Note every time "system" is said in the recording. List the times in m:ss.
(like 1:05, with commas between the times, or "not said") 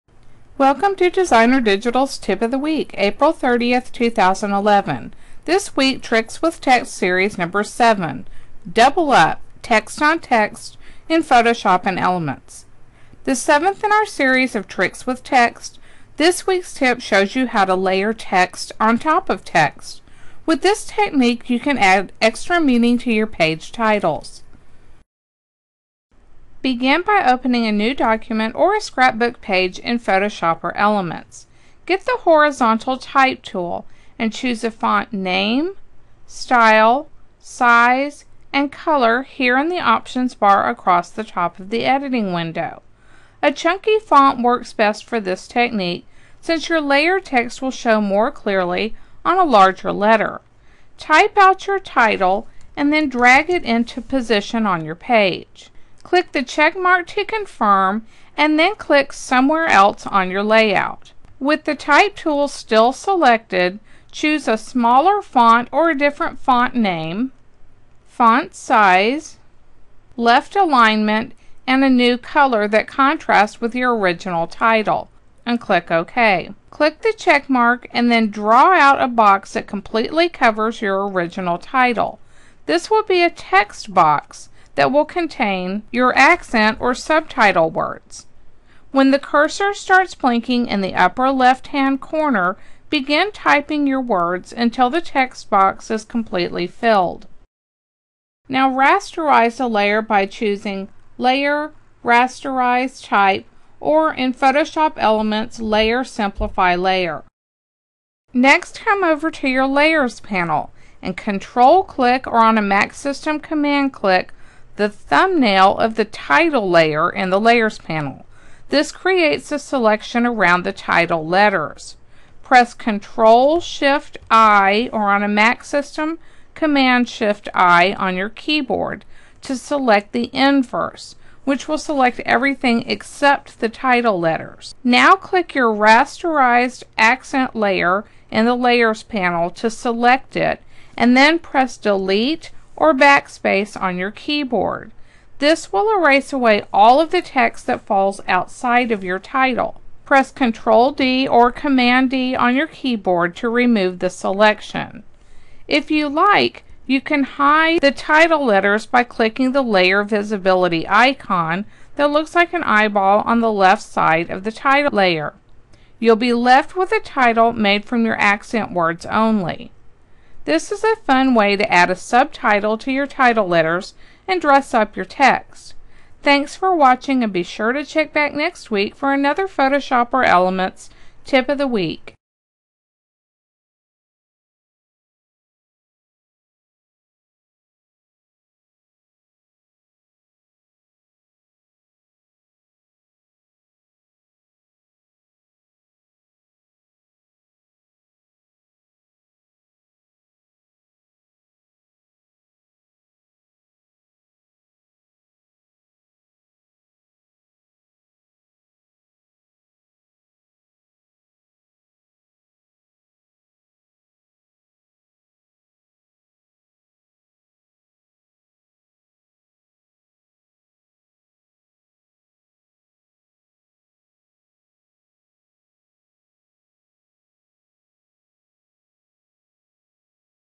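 1:52, 2:05.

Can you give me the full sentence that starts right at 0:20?
With this technique, you can add extra meaning to your page titles.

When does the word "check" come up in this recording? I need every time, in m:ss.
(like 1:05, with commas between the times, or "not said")
0:56, 1:17, 2:57.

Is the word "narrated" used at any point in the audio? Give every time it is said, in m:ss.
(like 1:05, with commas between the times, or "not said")
not said.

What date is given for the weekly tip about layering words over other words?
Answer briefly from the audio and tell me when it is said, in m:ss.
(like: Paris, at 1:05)
April 30th, 2011, at 0:02.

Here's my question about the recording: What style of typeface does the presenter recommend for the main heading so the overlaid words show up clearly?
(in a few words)
chunky font.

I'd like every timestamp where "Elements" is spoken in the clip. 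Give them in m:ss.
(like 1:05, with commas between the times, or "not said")
0:11, 0:30, 1:44, 3:00.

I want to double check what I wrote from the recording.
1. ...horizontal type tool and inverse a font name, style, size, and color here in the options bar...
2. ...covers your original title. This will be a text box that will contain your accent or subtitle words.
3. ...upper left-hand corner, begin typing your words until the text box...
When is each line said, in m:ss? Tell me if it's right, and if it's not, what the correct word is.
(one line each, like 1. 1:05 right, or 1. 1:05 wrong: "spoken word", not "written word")
1. 0:32 wrong: "choose", not "inverse"
2. 1:20 right
3. 1:30 right.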